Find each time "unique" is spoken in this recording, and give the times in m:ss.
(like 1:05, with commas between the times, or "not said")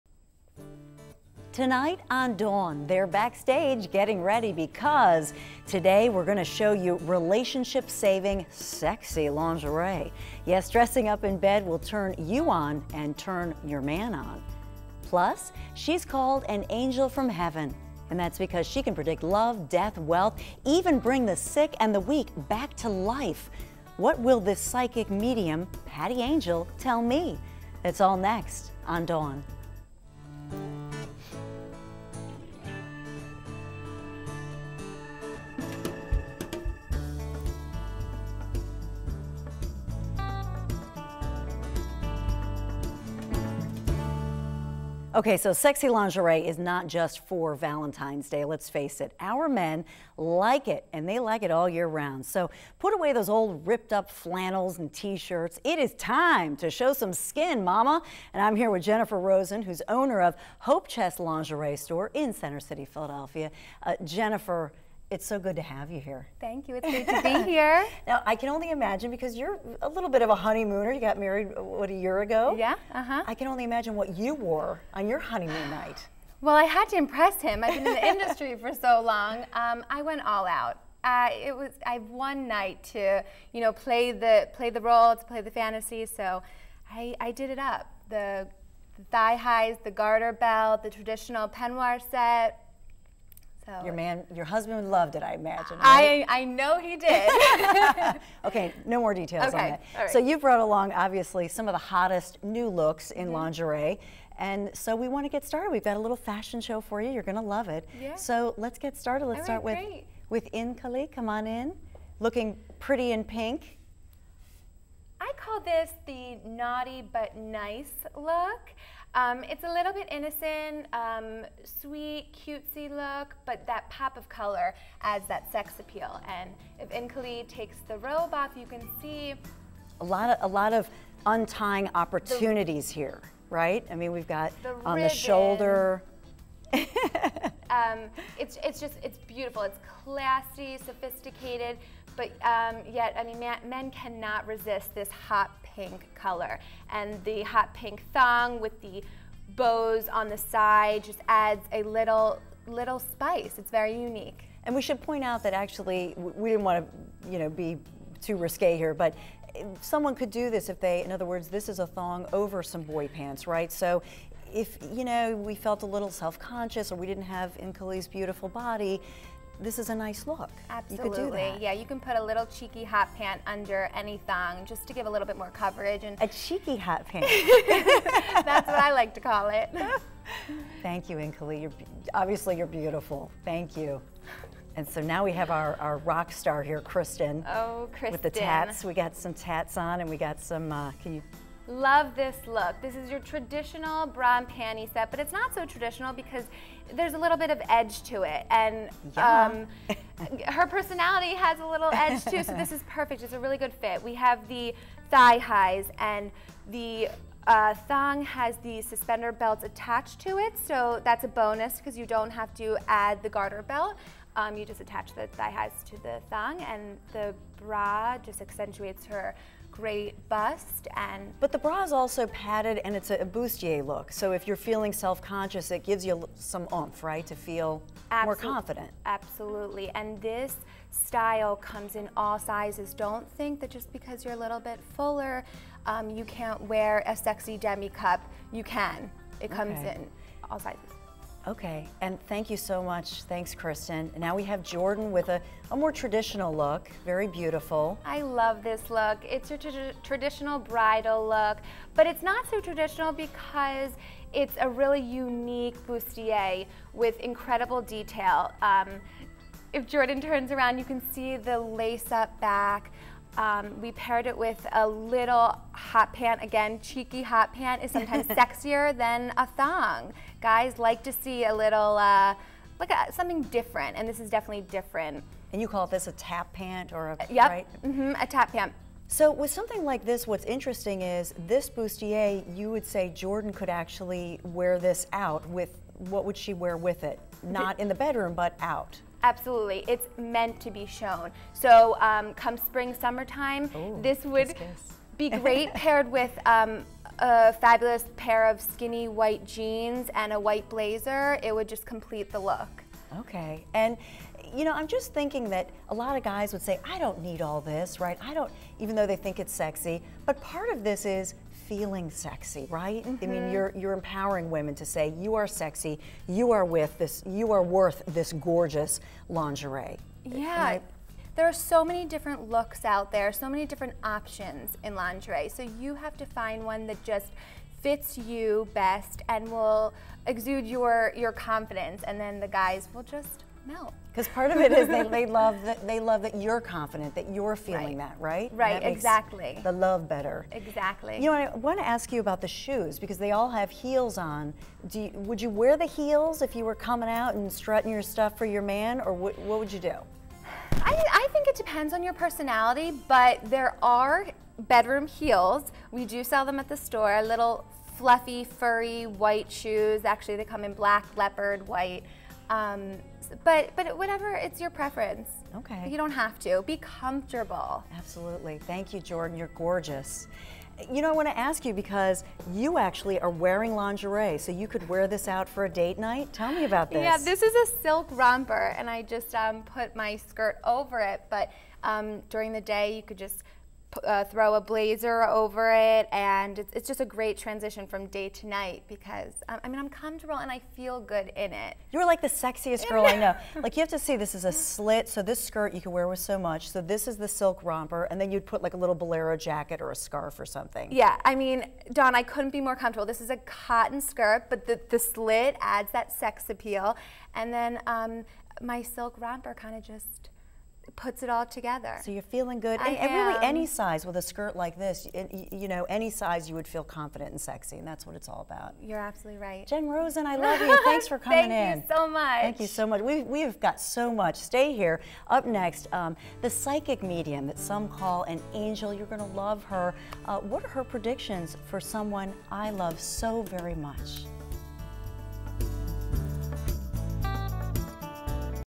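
2:33, 4:15.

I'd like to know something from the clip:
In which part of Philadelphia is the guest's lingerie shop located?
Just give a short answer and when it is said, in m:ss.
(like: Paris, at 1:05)
Center City, at 1:02.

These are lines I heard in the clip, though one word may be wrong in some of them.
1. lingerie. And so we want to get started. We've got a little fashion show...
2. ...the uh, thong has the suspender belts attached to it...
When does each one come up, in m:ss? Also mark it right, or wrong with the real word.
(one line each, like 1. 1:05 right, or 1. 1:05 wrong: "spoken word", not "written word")
1. 1:43 right
2. 3:26 right.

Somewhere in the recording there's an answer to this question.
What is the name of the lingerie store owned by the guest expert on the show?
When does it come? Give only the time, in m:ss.
1:00.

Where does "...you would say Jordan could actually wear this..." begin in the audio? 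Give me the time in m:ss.
4:42.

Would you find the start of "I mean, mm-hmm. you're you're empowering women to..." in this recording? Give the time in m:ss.
5:13.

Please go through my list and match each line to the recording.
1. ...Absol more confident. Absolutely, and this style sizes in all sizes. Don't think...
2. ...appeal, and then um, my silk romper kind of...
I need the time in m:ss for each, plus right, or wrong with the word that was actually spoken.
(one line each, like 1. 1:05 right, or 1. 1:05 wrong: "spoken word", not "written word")
1. 3:48 wrong: "comes", not "sizes"
2. 6:46 right.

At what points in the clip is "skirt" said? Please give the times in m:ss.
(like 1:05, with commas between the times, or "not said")
6:20, 6:35, 6:44, 6:54.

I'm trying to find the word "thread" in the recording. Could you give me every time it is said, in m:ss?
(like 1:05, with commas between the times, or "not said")
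not said.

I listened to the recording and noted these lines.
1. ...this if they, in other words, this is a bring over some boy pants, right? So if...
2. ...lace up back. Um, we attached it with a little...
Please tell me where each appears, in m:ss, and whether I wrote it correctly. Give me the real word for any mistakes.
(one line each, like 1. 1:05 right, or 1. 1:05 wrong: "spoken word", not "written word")
1. 2:40 wrong: "thong", not "bring"
2. 4:21 wrong: "paired", not "attached".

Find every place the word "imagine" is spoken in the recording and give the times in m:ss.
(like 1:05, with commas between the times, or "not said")
1:08, 1:13, 1:35.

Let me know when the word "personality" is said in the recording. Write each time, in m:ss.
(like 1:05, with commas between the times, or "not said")
3:20, 5:52.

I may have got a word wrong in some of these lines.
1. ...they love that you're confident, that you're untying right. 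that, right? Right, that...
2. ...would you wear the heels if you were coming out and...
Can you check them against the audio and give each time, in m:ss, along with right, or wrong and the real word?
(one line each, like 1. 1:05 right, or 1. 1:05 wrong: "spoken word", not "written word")
1. 5:35 wrong: "feeling", not "untying"
2. 5:45 right.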